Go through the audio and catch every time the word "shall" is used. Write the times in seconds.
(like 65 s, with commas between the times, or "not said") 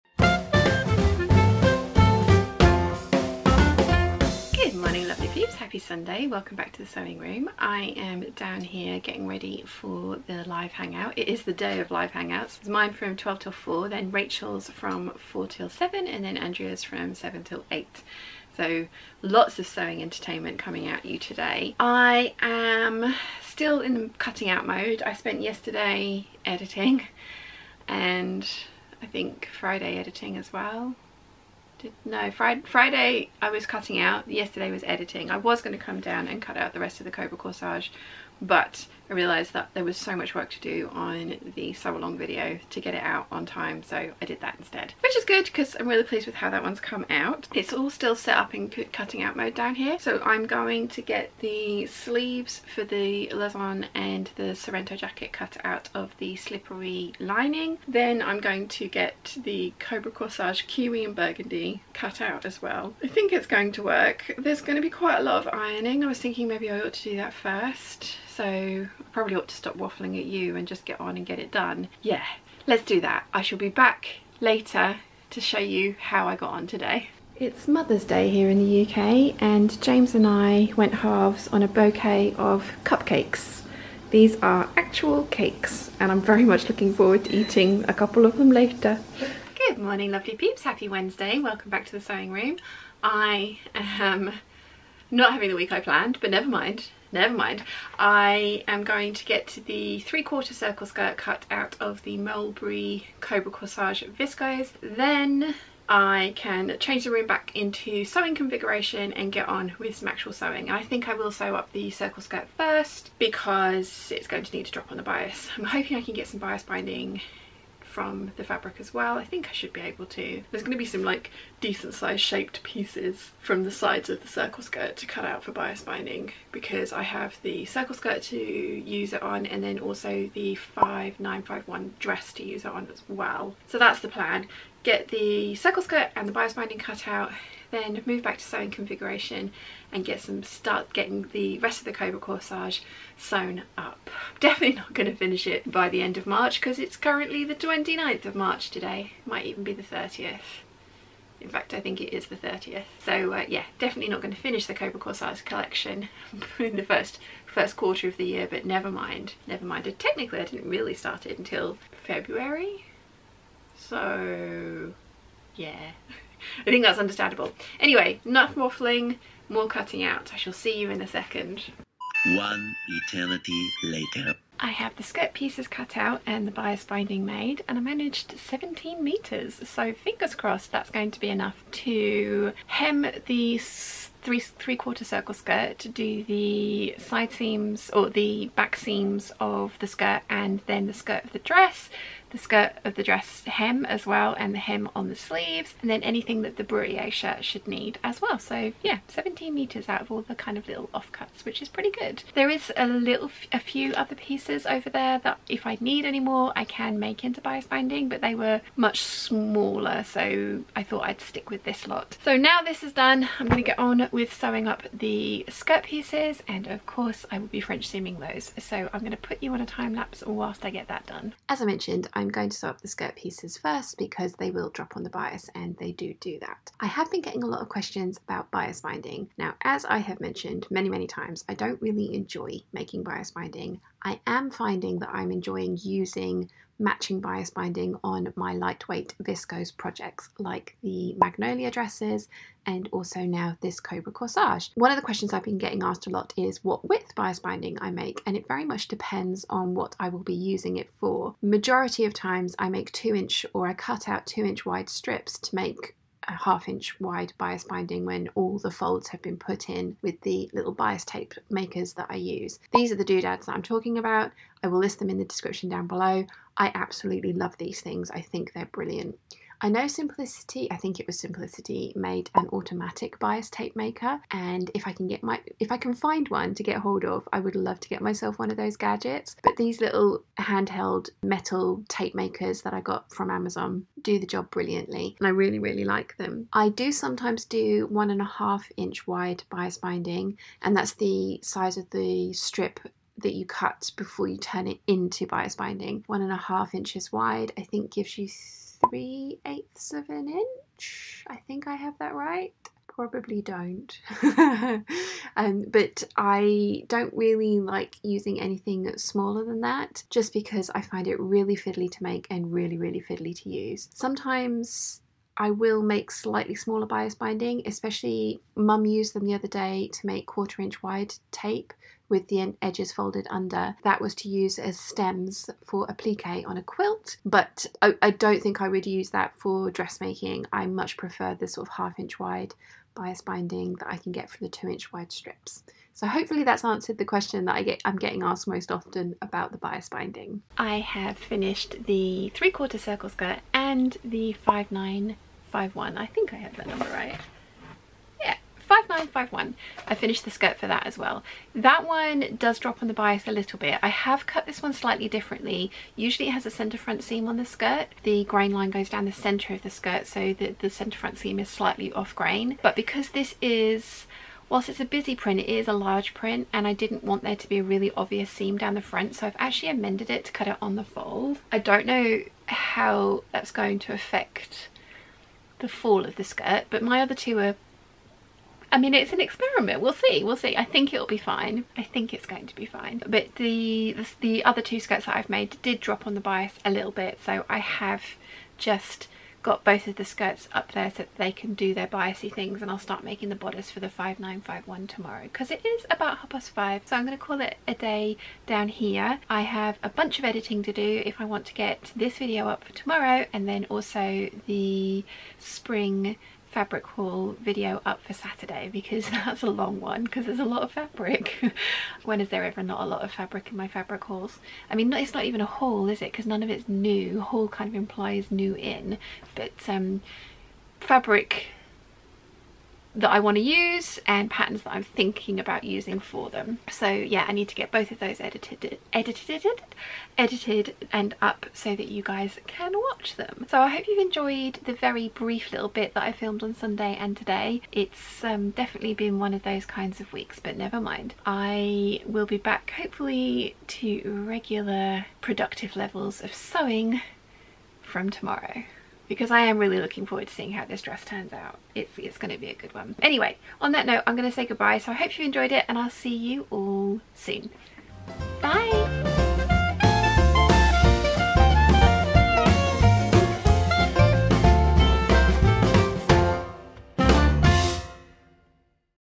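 73 s, 170 s.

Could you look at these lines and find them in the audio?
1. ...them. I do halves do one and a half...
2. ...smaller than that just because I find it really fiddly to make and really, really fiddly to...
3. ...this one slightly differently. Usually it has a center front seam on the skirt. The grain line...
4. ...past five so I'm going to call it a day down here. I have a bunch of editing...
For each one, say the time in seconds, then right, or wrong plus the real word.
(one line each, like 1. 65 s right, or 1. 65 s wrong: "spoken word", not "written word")
1. 286 s wrong: "sometimes", not "halves"
2. 308 s right
3. 354 s right
4. 396 s right.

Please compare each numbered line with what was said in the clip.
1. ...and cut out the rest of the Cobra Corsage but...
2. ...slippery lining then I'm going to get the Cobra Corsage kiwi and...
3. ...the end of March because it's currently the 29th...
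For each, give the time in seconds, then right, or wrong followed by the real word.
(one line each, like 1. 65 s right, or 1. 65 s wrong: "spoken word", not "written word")
1. 36 s right
2. 56 s right
3. 145 s right.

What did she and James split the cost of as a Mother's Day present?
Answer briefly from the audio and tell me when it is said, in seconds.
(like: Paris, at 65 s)
a bouquet of cupcakes, at 81 s.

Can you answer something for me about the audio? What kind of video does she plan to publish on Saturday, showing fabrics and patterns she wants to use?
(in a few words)
spring fabric haul.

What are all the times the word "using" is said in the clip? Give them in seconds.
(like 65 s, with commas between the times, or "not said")
235 s, 250 s, 308 s, 425 s.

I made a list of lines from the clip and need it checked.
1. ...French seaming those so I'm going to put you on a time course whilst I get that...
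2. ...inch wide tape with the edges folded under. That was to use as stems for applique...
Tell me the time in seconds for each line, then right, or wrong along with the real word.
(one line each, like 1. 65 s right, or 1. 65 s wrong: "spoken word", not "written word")
1. 217 s wrong: "lapse", not "course"
2. 320 s right.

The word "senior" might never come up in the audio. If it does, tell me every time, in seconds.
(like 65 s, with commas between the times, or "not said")
not said.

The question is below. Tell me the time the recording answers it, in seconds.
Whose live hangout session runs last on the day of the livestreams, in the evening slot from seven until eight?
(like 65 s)
16 s.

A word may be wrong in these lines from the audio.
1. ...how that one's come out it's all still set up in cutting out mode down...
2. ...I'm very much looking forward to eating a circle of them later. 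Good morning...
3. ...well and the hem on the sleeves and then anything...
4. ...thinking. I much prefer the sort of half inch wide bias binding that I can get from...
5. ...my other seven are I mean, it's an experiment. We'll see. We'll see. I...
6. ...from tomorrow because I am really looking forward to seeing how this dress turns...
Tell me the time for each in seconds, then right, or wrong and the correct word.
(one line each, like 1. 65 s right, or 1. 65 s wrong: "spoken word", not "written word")
1. 46 s right
2. 86 s wrong: "couple", not "circle"
3. 194 s right
4. 329 s wrong: "dressmaking", not "thinking"
5. 376 s wrong: "two", not "seven"
6. 447 s right.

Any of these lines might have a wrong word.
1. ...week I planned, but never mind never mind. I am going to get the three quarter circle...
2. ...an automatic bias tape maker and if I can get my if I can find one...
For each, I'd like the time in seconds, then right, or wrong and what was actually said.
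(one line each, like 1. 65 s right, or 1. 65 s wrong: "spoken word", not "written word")
1. 95 s right
2. 272 s right.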